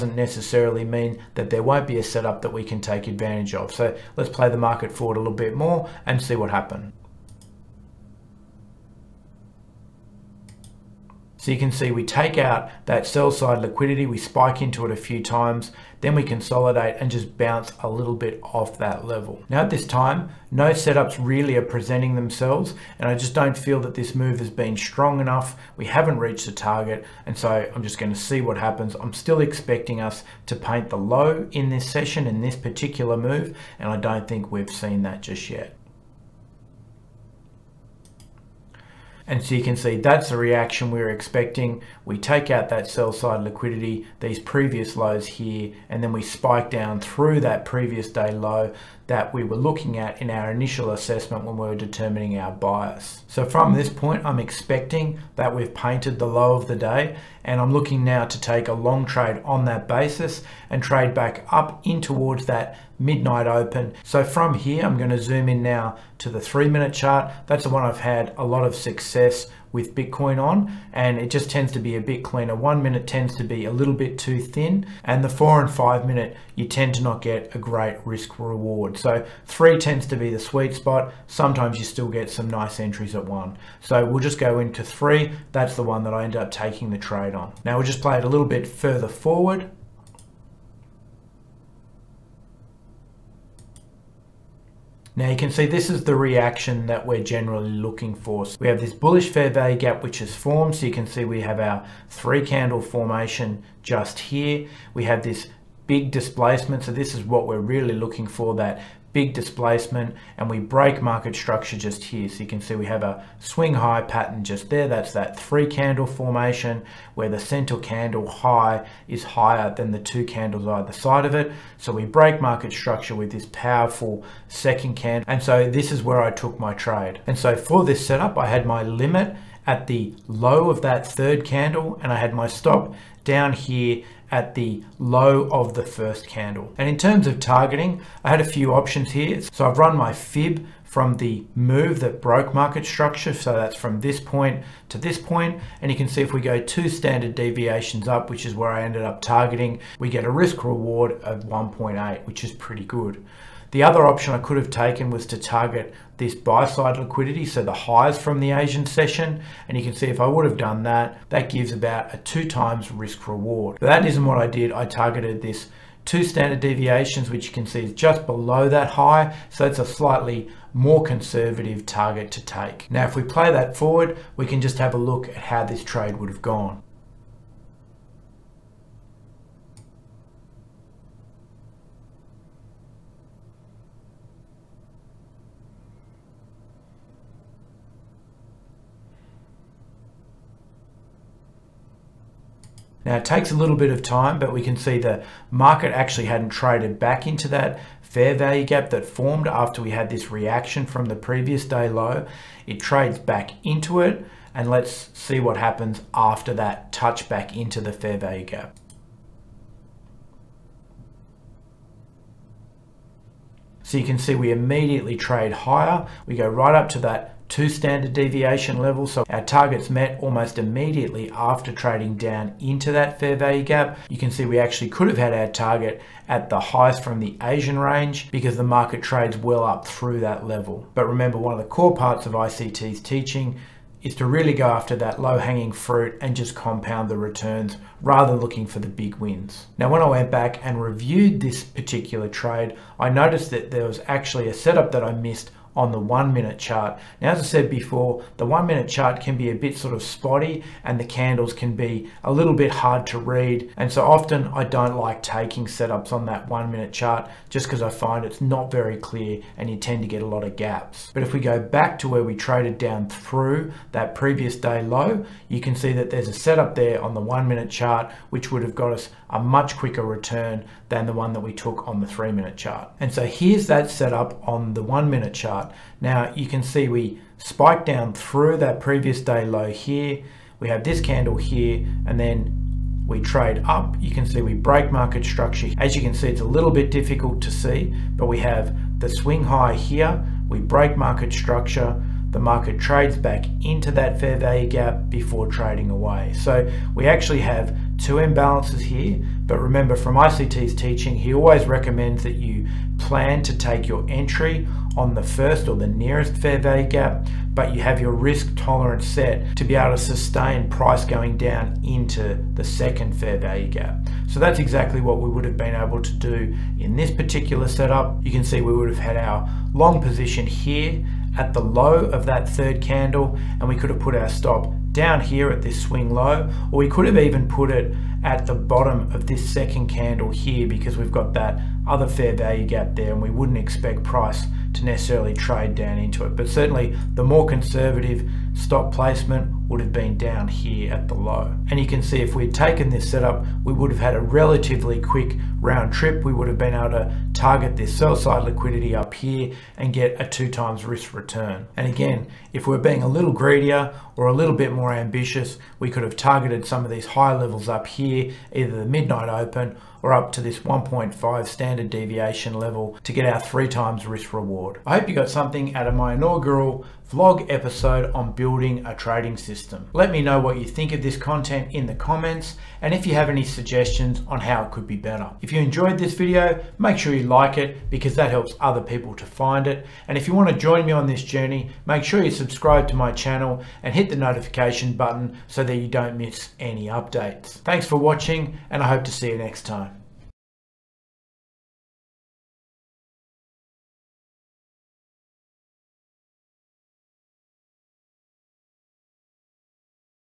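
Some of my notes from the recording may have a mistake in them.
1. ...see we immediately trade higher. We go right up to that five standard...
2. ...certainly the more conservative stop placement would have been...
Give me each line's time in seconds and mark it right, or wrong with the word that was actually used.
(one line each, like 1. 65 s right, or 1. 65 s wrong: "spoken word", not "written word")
1. 214 s wrong: "two", not "five"
2. 336 s right.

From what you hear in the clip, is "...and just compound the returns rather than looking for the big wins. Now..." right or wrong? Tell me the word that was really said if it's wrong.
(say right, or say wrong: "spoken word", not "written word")
right.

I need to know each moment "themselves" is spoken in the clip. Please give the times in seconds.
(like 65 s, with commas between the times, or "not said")
22 s.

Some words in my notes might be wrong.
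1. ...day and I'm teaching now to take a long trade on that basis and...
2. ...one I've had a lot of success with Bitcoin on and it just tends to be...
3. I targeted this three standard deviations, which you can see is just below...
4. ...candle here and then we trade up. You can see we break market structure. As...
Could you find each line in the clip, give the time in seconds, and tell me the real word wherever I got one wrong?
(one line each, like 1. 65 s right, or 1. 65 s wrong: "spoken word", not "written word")
1. 56 s wrong: "looking", not "teaching"
2. 67 s right
3. 164 s wrong: "two", not "three"
4. 281 s right.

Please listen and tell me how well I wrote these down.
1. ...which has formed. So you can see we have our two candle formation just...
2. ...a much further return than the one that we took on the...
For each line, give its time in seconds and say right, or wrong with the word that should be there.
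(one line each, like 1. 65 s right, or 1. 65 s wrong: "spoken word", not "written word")
1. 100 s wrong: "three", not "two"
2. 269 s wrong: "quicker", not "further".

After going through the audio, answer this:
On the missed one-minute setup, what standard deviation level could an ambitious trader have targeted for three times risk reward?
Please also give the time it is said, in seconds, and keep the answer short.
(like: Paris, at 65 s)
1.5, at 360 s.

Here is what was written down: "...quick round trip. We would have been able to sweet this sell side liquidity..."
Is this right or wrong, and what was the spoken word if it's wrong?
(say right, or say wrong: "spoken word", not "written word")
wrong: "target", not "sweet".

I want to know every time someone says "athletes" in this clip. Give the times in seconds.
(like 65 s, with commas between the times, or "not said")
not said.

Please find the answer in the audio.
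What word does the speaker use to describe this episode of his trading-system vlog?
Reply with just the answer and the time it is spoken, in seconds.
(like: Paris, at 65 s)
inaugural, at 366 s.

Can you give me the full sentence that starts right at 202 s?
It trades back into it and let's see what happens after that touch back into the fair value gap.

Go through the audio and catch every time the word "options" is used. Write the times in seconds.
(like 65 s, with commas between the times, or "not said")
138 s, 154 s.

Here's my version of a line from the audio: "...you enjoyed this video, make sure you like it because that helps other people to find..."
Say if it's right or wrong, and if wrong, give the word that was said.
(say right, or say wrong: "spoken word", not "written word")
right.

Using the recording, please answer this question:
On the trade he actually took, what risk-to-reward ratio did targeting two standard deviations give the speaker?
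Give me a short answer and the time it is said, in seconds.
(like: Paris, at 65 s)
1.8, at 151 s.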